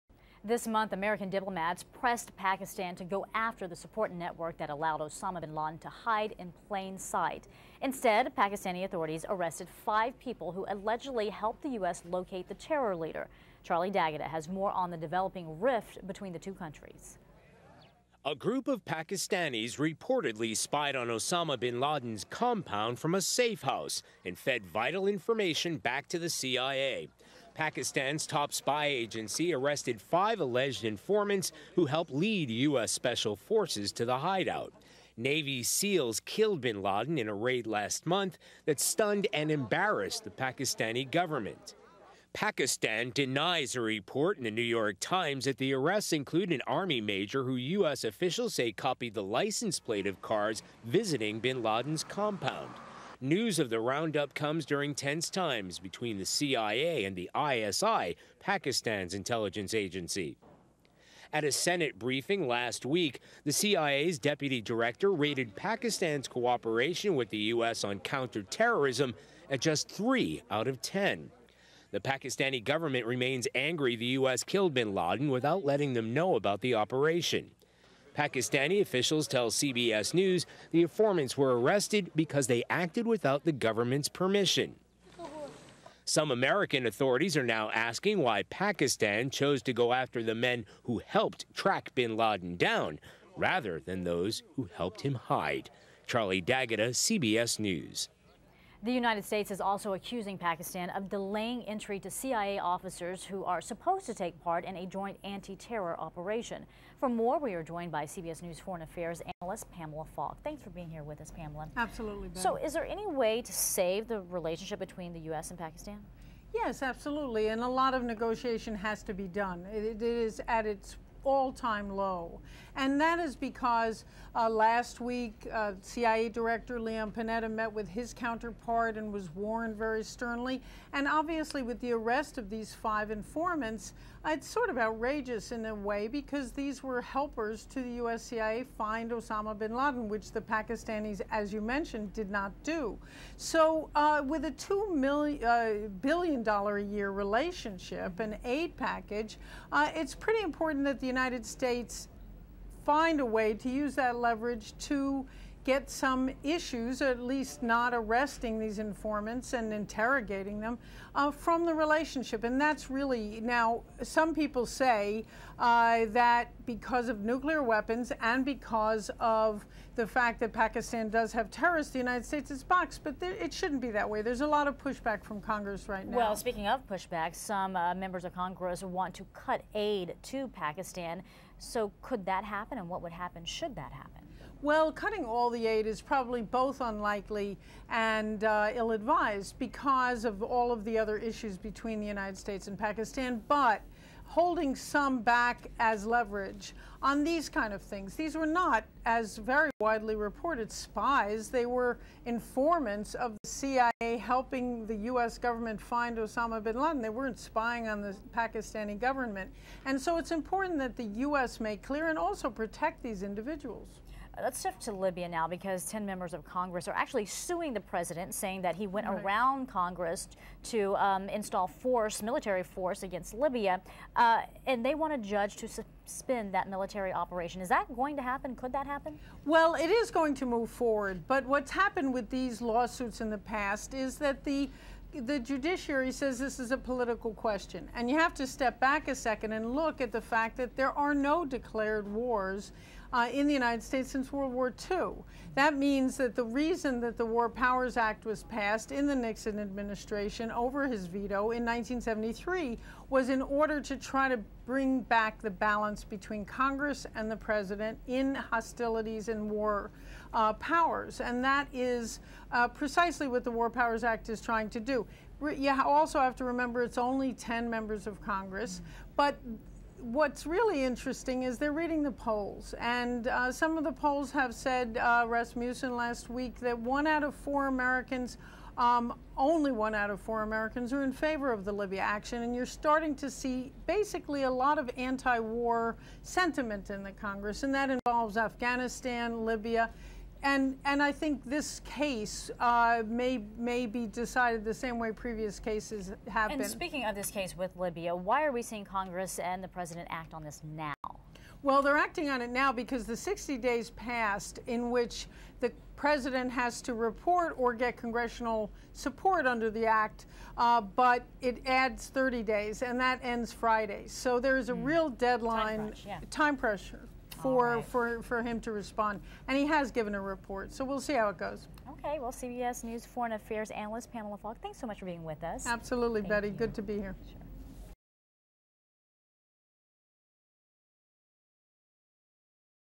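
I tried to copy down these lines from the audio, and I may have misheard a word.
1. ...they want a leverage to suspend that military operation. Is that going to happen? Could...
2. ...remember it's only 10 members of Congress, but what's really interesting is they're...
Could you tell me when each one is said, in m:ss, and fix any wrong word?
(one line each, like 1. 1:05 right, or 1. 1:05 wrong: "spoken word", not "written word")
1. 3:44 wrong: "judge", not "leverage"
2. 4:26 right.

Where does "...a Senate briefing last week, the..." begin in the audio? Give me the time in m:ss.
1:01.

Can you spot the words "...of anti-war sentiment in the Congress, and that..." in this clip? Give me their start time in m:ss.
4:44.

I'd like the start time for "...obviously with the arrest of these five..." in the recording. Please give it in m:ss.
2:11.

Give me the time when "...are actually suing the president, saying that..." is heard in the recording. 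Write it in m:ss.
3:36.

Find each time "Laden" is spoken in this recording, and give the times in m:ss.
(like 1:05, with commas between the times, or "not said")
0:05, 0:21, 0:36, 0:51, 1:14, 1:32, 2:19, 3:26.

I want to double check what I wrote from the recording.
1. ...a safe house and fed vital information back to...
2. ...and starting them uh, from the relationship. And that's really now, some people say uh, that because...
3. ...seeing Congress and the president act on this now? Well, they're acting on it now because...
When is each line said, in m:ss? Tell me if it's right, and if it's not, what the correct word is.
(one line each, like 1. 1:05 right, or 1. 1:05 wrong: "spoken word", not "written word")
1. 0:23 right
2. 2:39 wrong: "interrogating", not "starting"
3. 4:58 right.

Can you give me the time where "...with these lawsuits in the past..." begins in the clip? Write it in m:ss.
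3:52.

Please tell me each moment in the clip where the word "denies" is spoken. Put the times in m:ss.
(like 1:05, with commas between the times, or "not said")
0:43.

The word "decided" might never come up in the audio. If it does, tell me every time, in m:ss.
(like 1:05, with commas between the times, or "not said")
4:54.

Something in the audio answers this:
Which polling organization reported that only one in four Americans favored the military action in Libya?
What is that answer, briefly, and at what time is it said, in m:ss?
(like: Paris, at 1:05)
Rasmussen, at 4:35.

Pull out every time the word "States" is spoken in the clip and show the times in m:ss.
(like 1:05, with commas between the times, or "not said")
1:39, 2:31, 2:52, 3:12, 4:03.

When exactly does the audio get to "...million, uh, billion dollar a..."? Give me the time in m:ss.
2:24.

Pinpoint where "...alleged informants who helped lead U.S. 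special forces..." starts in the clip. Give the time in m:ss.
0:30.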